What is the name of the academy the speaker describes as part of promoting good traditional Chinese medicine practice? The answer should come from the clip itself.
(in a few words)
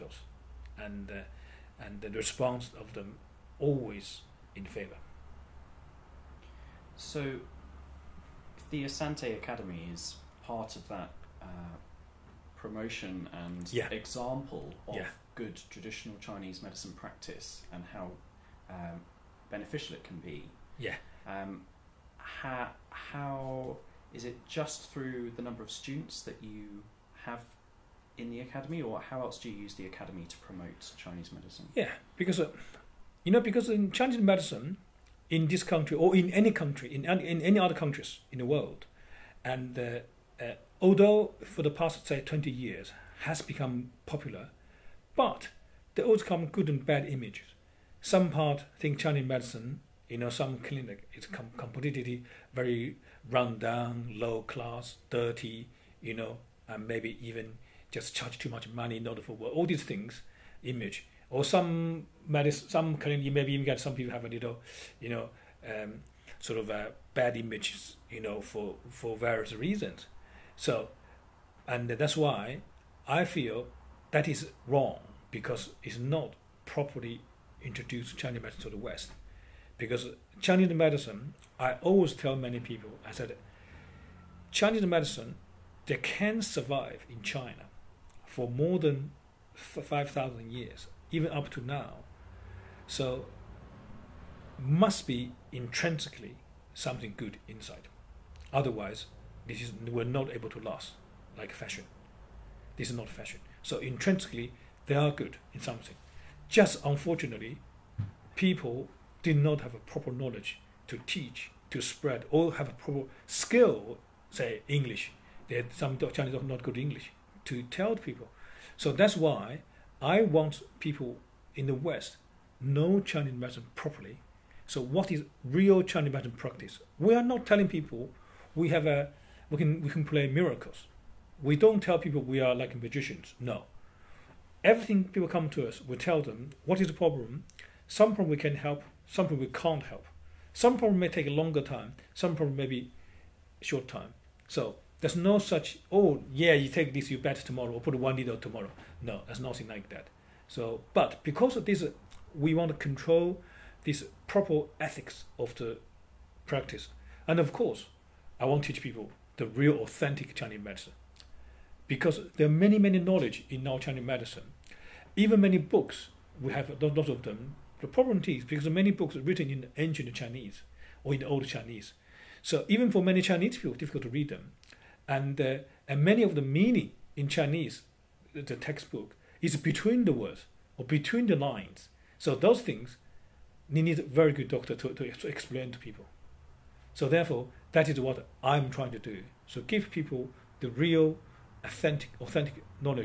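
Asante Academy.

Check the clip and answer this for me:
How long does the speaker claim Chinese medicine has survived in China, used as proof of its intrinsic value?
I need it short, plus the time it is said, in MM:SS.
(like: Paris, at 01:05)
More than 5,000 years, at 01:28.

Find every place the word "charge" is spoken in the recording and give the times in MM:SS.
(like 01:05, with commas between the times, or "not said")
00:58.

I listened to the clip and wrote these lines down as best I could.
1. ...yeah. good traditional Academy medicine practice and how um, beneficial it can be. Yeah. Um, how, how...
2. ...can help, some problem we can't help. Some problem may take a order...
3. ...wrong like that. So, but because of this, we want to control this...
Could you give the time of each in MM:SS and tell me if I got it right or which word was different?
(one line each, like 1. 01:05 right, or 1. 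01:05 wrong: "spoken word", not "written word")
1. 00:14 wrong: "Chinese", not "Academy"
2. 02:18 wrong: "longer", not "order"
3. 02:29 wrong: "nothing", not "wrong".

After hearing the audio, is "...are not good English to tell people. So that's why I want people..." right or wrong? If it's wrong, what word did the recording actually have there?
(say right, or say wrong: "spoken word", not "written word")
right.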